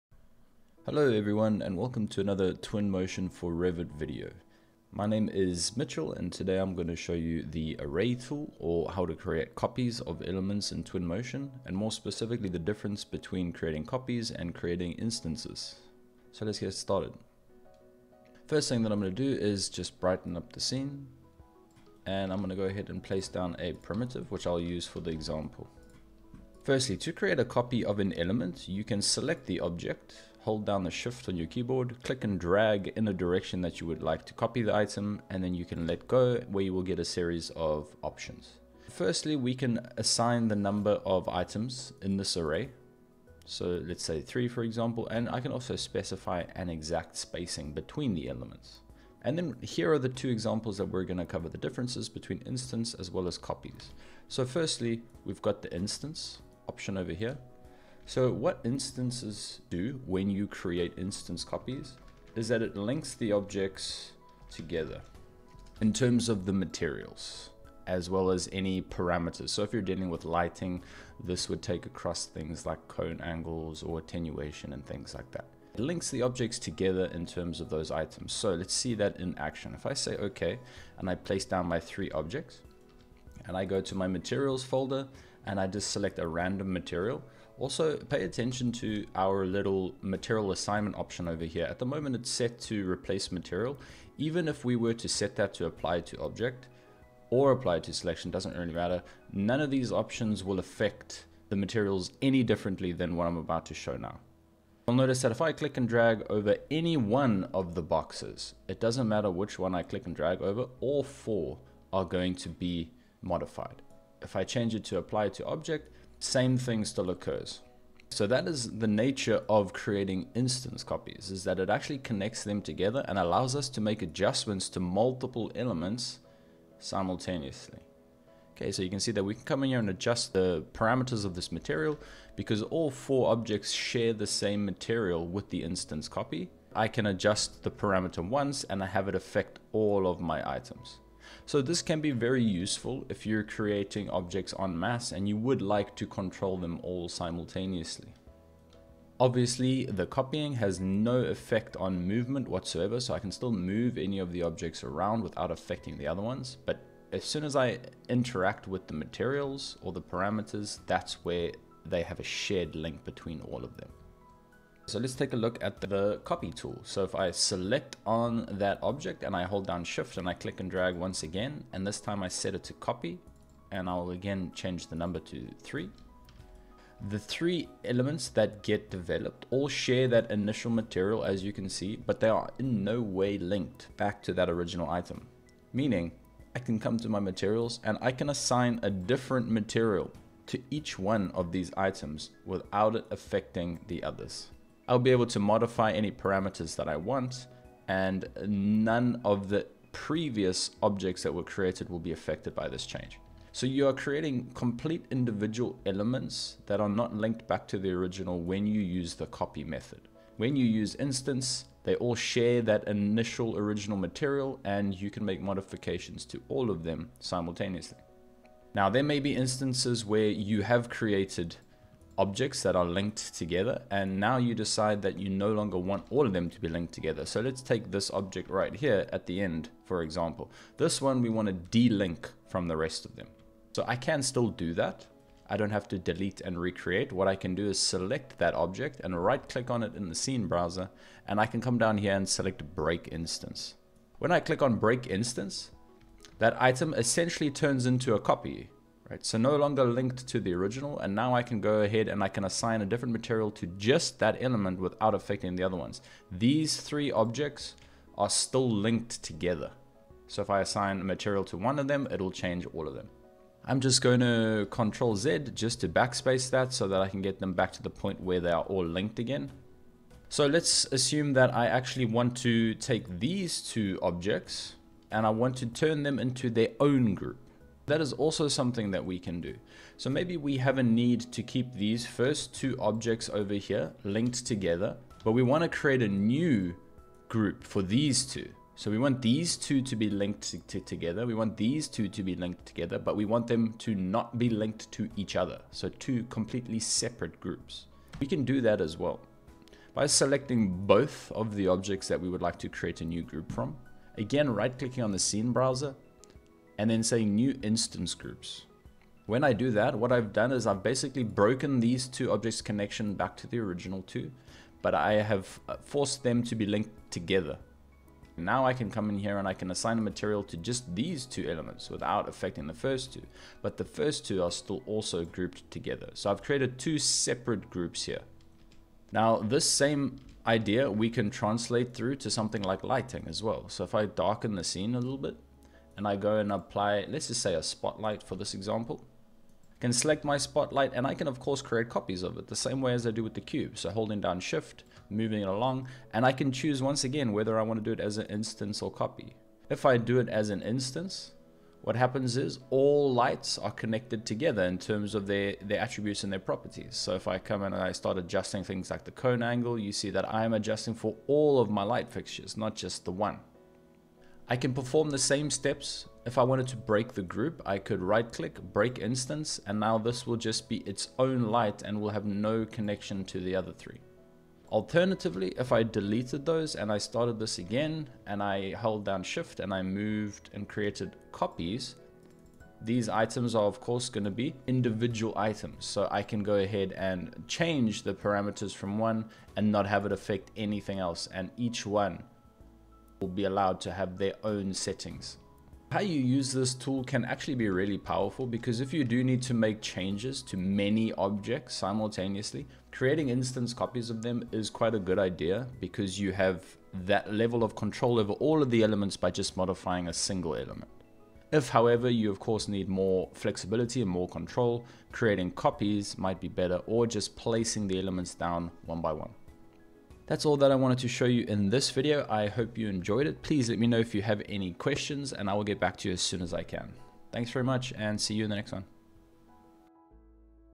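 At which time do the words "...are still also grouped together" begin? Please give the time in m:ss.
5:24.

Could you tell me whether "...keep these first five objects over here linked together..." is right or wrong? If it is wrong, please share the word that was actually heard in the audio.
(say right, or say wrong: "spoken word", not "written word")
wrong: "two", not "five".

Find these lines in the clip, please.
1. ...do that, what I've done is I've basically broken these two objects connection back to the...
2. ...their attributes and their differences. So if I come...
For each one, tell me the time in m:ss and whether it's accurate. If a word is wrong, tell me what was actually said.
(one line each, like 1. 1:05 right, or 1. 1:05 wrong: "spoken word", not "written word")
1. 5:09 right
2. 5:55 wrong: "properties", not "differences".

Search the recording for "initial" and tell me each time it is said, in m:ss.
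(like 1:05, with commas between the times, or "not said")
3:00, 3:32.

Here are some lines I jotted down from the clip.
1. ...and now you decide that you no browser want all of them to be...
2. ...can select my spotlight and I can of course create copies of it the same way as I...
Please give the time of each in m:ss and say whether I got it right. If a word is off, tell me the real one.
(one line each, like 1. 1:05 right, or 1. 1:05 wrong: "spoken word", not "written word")
1. 3:43 wrong: "longer", not "browser"
2. 5:39 right.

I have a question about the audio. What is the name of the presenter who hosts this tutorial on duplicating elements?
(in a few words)
Mitchell.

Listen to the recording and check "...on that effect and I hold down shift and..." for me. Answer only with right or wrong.
wrong.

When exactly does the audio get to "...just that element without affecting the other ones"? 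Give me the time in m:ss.
4:13.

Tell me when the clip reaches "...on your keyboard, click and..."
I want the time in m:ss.
0:31.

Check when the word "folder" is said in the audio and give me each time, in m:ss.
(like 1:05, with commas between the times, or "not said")
1:24.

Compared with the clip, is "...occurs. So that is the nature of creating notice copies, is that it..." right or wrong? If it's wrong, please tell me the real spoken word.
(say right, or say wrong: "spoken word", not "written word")
wrong: "instance", not "notice".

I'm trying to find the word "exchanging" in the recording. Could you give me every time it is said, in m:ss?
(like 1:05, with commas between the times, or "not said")
not said.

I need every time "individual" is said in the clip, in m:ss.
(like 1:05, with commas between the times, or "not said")
3:25, 6:24.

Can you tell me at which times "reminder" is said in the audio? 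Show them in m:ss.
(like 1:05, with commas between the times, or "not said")
not said.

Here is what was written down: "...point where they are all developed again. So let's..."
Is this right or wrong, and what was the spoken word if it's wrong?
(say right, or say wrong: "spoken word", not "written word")
wrong: "linked", not "developed".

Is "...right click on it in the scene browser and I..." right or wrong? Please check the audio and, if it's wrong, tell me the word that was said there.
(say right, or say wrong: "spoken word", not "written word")
right.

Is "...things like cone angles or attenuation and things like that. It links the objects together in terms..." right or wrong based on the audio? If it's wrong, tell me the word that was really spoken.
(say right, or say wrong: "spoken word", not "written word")
right.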